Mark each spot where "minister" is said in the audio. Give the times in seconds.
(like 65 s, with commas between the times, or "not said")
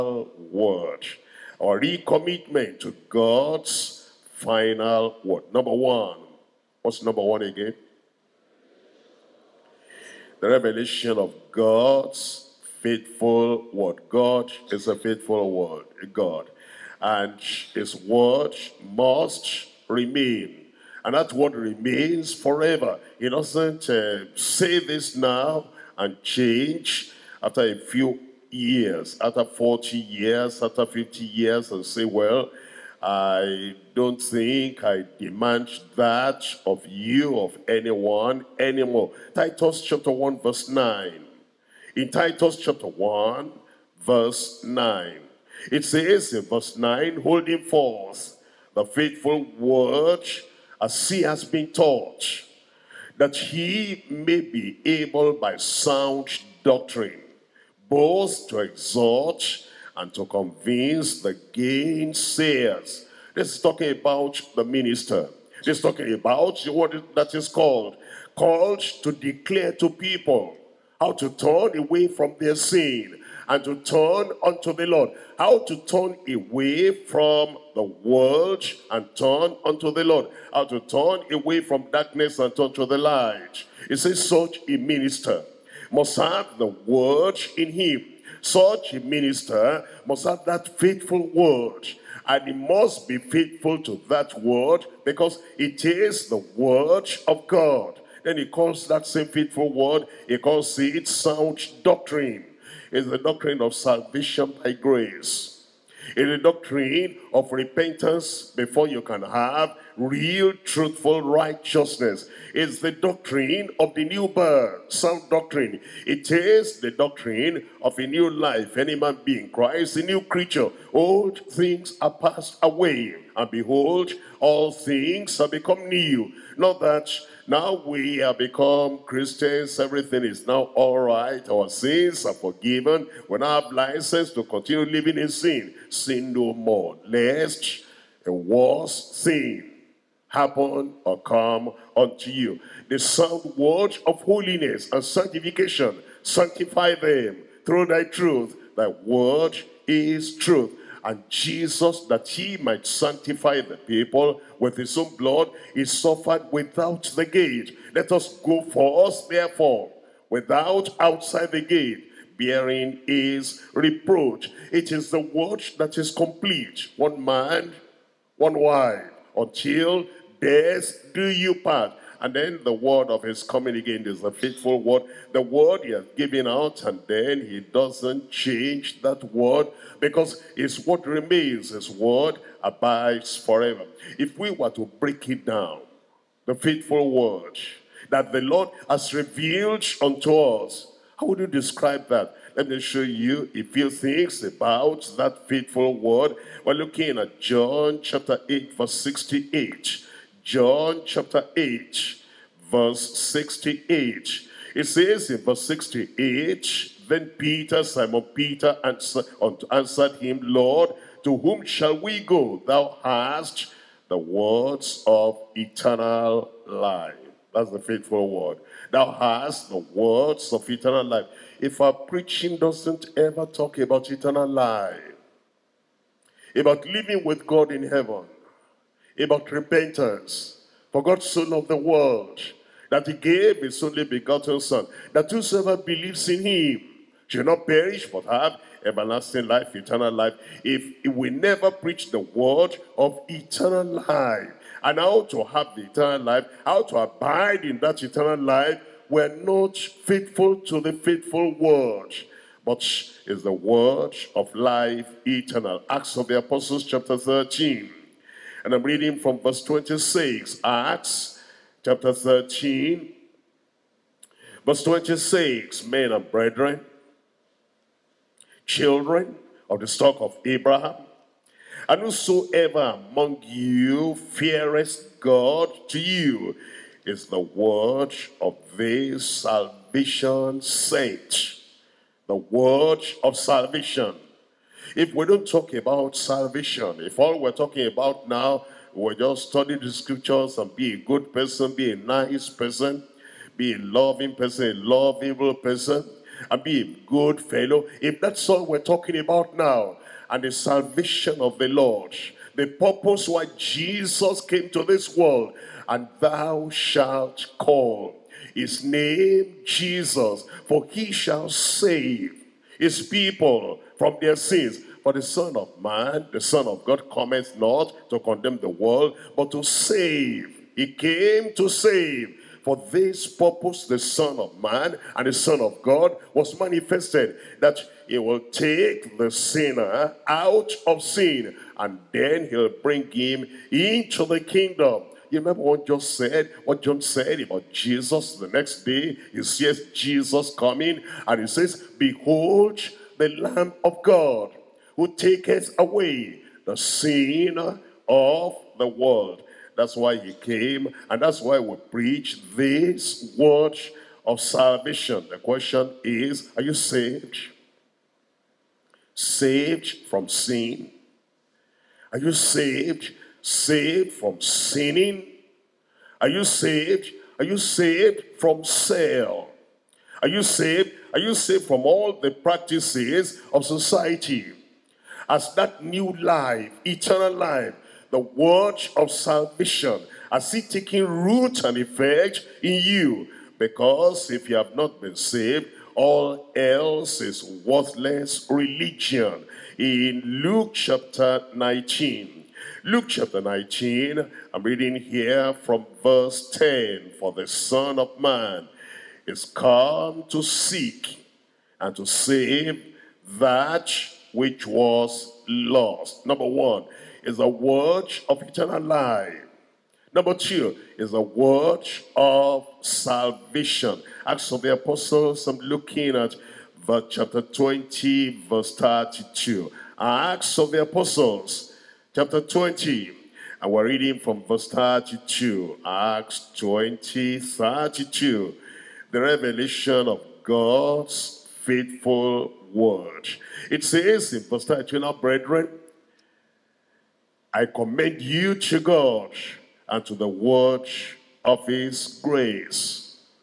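64 s, 84 s, 88 s.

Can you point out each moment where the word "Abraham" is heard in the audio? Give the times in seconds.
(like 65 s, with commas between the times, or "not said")
270 s.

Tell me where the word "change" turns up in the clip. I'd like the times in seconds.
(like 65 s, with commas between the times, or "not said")
26 s, 178 s.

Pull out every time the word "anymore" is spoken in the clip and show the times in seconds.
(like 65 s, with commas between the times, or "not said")
38 s.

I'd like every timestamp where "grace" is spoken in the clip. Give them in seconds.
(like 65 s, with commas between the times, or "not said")
104 s, 442 s.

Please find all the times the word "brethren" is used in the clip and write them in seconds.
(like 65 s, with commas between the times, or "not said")
266 s, 435 s.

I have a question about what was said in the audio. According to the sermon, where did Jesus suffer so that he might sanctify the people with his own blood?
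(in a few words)
Without the gate.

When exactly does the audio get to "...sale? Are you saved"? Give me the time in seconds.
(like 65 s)
368 s.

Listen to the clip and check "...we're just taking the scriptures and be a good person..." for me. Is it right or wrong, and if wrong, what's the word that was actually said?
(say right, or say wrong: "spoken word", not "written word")
wrong: "studying", not "taking".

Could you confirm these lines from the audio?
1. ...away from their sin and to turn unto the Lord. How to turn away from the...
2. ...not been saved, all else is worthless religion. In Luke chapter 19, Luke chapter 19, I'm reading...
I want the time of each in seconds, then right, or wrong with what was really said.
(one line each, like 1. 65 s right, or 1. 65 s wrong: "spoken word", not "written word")
1. 71 s right
2. 384 s right.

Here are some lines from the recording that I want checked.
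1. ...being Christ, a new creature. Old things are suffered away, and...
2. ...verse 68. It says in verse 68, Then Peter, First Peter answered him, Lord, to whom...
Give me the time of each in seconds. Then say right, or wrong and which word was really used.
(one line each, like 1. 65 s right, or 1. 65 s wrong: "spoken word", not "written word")
1. 119 s wrong: "passed", not "suffered"
2. 202 s wrong: "Simon", not "First".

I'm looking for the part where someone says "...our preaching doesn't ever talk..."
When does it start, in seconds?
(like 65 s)
221 s.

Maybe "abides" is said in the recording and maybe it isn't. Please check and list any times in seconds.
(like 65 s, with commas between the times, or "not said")
182 s, 246 s.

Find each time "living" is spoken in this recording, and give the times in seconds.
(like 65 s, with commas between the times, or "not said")
134 s, 226 s.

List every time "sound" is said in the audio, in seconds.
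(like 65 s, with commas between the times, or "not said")
55 s, 101 s, 114 s, 142 s.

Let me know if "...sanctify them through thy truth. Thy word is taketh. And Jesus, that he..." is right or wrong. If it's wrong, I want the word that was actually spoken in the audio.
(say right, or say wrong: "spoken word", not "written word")
wrong: "truth", not "taketh".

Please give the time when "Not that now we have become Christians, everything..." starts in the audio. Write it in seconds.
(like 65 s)
126 s.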